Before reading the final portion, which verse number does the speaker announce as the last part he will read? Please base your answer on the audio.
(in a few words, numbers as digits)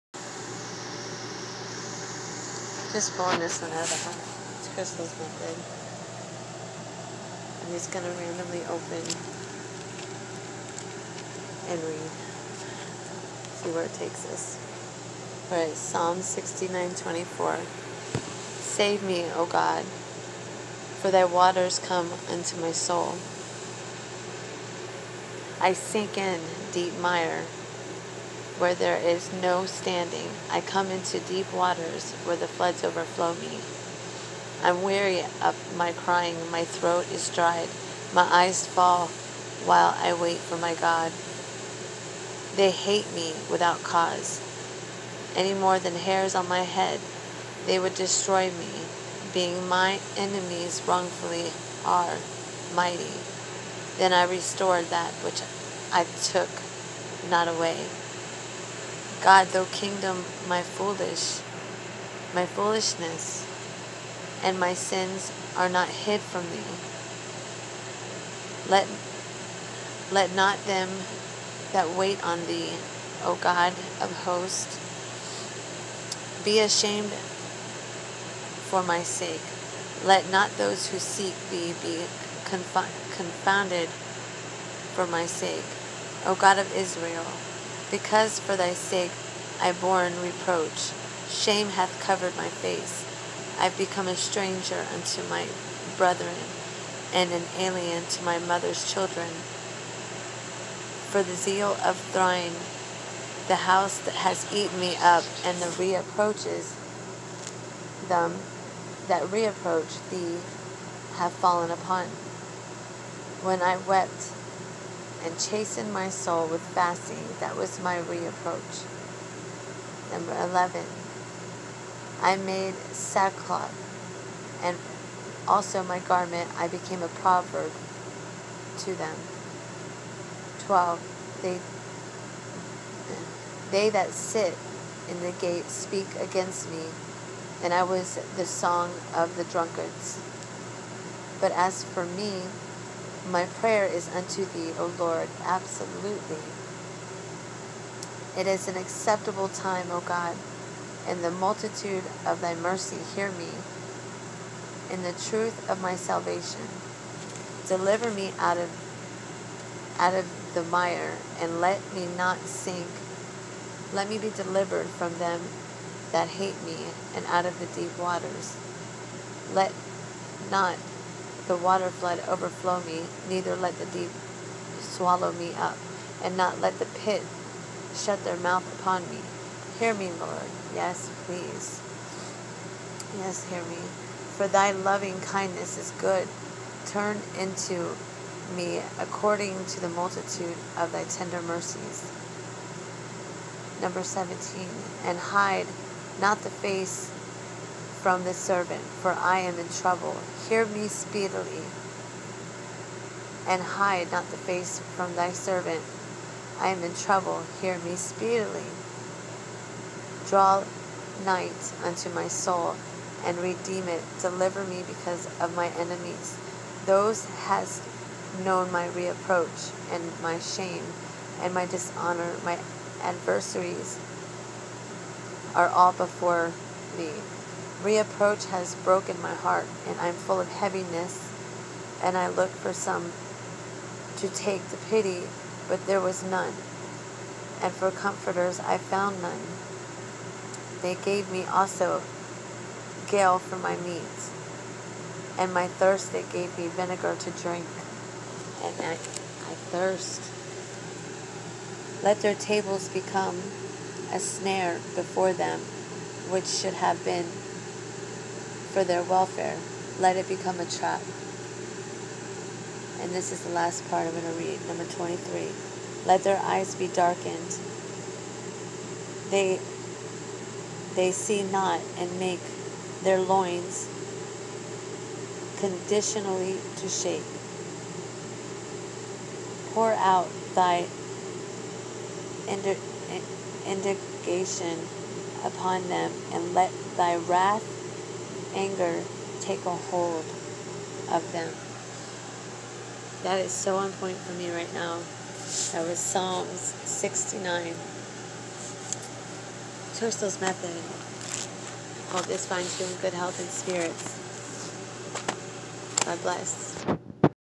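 23.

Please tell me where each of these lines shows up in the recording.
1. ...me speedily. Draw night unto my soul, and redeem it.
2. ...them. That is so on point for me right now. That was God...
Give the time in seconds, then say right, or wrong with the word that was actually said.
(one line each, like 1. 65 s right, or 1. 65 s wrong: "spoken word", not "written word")
1. 207 s right
2. 291 s wrong: "Psalms", not "God".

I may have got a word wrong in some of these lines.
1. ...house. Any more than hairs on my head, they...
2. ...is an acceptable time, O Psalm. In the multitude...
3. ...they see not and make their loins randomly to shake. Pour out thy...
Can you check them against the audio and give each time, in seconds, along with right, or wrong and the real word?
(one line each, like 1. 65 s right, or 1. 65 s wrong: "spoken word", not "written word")
1. 43 s wrong: "cause", not "house"
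2. 148 s wrong: "God", not "Psalm"
3. 270 s wrong: "conditionally", not "randomly".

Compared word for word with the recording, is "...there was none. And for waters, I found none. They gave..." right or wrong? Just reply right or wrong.
wrong.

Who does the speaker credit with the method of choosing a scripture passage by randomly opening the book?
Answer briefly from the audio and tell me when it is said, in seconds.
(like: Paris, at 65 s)
Krystle, at 4 s.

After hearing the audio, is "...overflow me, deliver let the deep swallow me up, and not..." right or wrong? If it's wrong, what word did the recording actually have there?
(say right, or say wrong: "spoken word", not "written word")
wrong: "neither", not "deliver".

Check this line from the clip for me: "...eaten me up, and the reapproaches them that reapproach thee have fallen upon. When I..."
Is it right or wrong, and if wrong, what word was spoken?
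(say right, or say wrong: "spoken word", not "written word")
right.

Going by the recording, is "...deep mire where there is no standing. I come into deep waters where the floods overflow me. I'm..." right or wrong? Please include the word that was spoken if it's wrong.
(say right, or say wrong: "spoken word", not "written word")
right.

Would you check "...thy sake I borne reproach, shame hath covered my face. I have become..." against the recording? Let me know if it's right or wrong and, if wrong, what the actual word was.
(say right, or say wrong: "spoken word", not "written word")
right.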